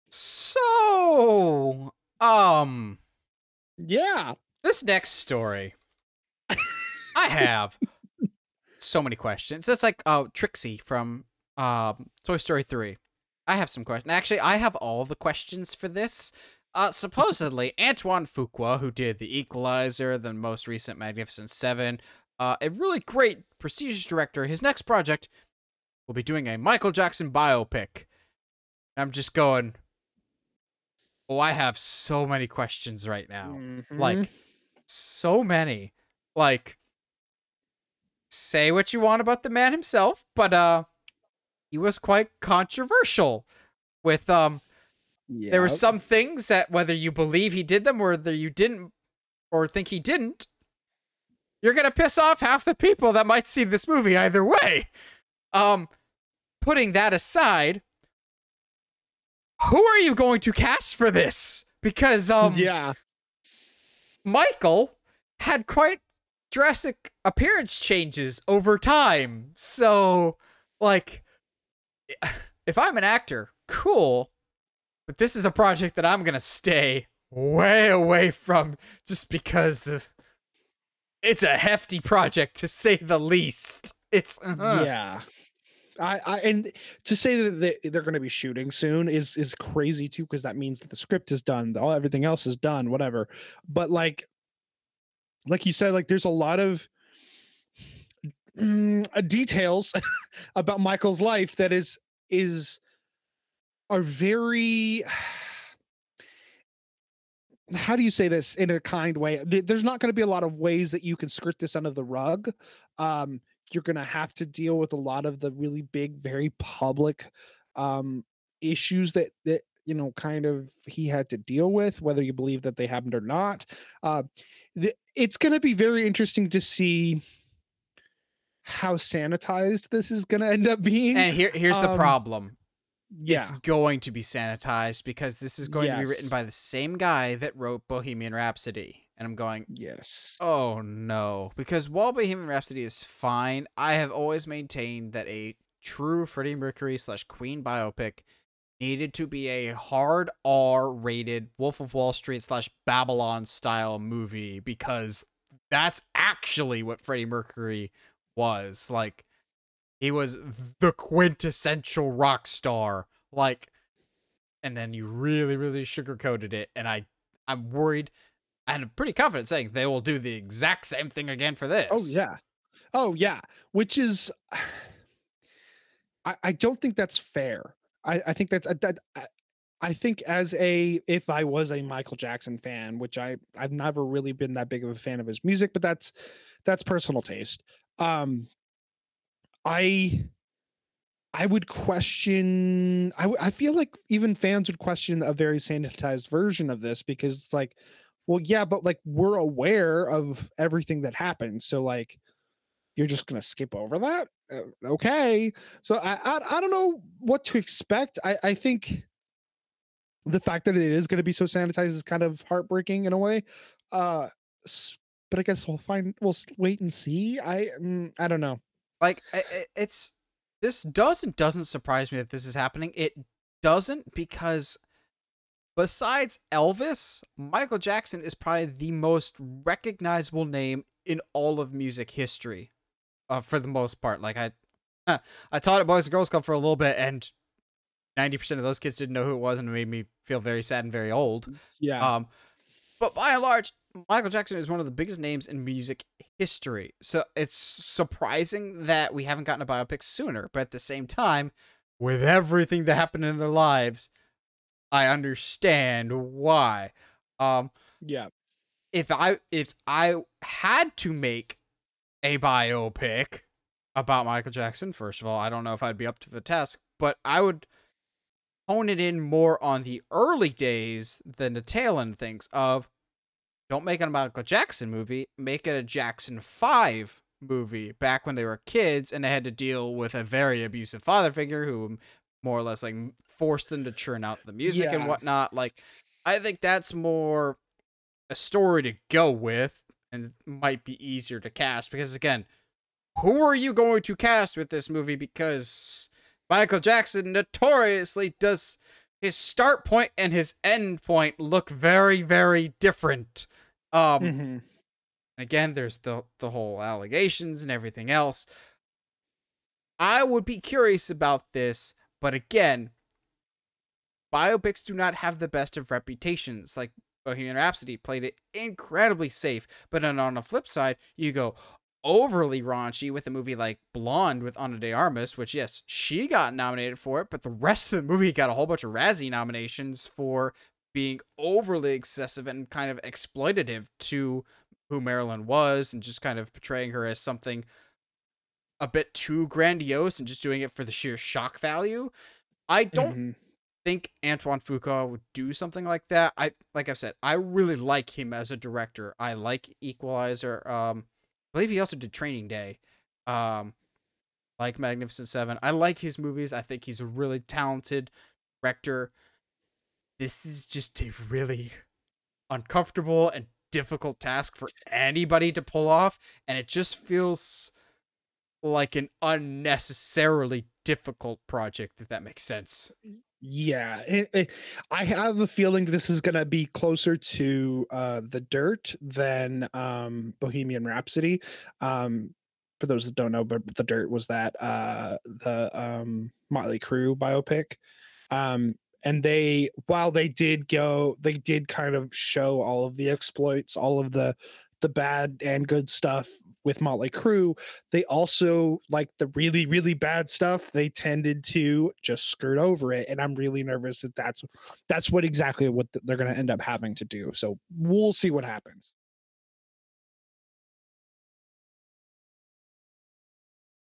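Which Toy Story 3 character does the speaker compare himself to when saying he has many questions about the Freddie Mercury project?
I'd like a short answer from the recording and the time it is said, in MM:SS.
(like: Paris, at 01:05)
Trixie, at 00:10.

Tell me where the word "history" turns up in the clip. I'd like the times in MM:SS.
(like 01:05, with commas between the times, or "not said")
03:52, 04:06.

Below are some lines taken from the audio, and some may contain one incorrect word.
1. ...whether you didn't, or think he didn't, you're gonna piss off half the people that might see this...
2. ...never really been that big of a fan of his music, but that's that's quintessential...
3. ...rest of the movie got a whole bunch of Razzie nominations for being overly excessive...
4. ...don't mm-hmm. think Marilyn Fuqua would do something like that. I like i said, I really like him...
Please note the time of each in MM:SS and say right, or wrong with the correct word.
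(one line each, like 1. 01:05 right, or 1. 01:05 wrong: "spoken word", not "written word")
1. 00:48 right
2. 03:03 wrong: "personal", not "quintessential"
3. 05:27 right
4. 05:42 wrong: "Antoine", not "Marilyn".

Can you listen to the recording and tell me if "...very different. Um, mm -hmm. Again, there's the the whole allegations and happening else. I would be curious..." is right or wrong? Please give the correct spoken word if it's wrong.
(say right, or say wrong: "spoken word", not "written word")
wrong: "everything", not "happening".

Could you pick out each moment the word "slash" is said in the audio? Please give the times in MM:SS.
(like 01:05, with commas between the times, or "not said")
02:26, 02:32.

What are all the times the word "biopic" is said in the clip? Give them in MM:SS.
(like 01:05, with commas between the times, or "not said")
00:27, 02:27, 04:09, 04:22, 05:14, 06:27.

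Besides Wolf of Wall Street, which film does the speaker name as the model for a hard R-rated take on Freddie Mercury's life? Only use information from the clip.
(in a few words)
Babylon.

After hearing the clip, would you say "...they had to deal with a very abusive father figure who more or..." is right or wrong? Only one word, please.
right.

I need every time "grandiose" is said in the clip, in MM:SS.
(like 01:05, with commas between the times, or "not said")
05:39.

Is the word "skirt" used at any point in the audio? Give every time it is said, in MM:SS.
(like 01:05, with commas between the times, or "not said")
01:51, 06:42.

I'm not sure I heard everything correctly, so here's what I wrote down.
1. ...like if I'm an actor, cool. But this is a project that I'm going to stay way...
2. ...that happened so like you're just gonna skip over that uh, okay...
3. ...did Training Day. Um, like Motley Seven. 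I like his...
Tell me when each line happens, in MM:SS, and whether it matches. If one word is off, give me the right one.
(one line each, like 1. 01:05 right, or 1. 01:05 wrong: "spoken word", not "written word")
1. 01:10 right
2. 03:21 right
3. 05:51 wrong: "Magnificent", not "Motley".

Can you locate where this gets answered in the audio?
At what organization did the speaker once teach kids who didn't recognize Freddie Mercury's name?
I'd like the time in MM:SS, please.
03:55.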